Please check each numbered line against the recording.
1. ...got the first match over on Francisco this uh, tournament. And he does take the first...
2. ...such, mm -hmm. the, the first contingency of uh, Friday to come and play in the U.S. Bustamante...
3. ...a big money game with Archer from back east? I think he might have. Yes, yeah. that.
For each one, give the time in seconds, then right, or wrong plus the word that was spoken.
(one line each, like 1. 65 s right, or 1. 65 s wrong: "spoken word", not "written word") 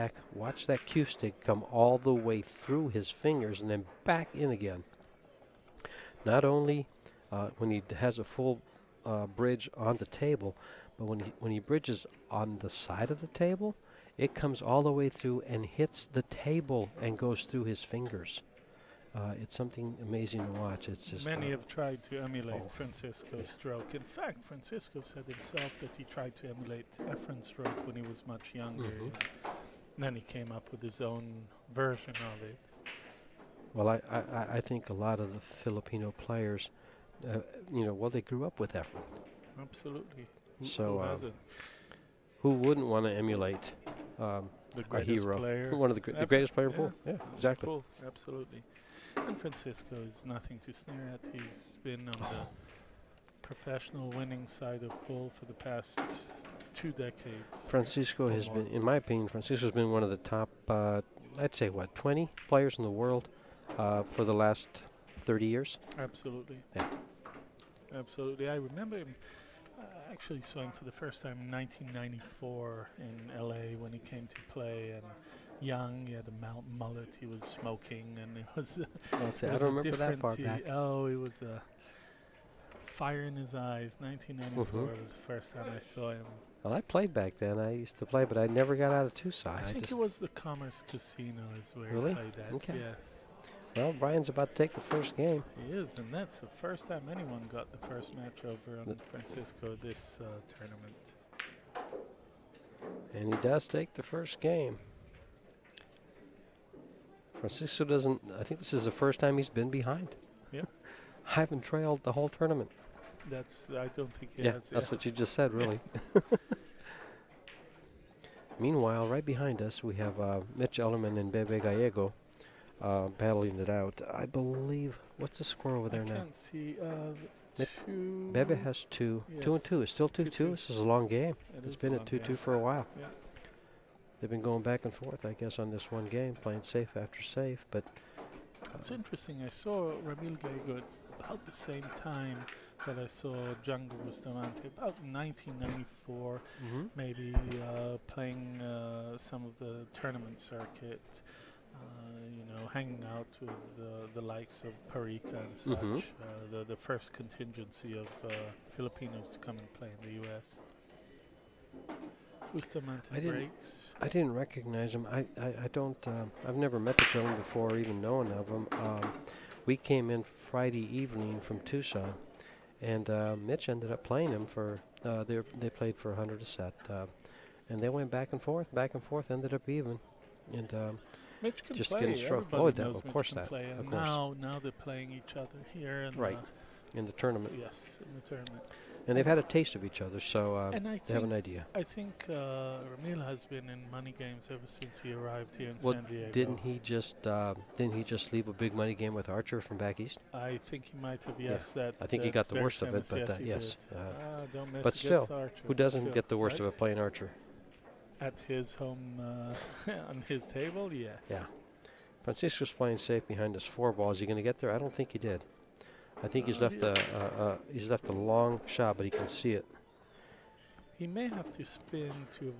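1. 97 s right
2. 155 s wrong: "Filipinos", not "Friday"
3. 198 s right.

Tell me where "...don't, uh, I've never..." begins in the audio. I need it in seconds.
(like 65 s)
165 s.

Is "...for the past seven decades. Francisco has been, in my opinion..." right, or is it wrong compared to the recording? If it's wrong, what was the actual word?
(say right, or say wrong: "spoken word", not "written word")
wrong: "two", not "seven".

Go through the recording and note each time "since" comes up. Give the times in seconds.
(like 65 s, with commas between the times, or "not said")
194 s.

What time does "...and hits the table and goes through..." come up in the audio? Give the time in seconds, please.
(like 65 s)
15 s.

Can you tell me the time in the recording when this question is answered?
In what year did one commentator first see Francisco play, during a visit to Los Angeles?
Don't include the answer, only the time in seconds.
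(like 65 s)
71 s.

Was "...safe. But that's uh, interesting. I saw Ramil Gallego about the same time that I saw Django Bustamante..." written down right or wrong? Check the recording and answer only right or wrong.
right.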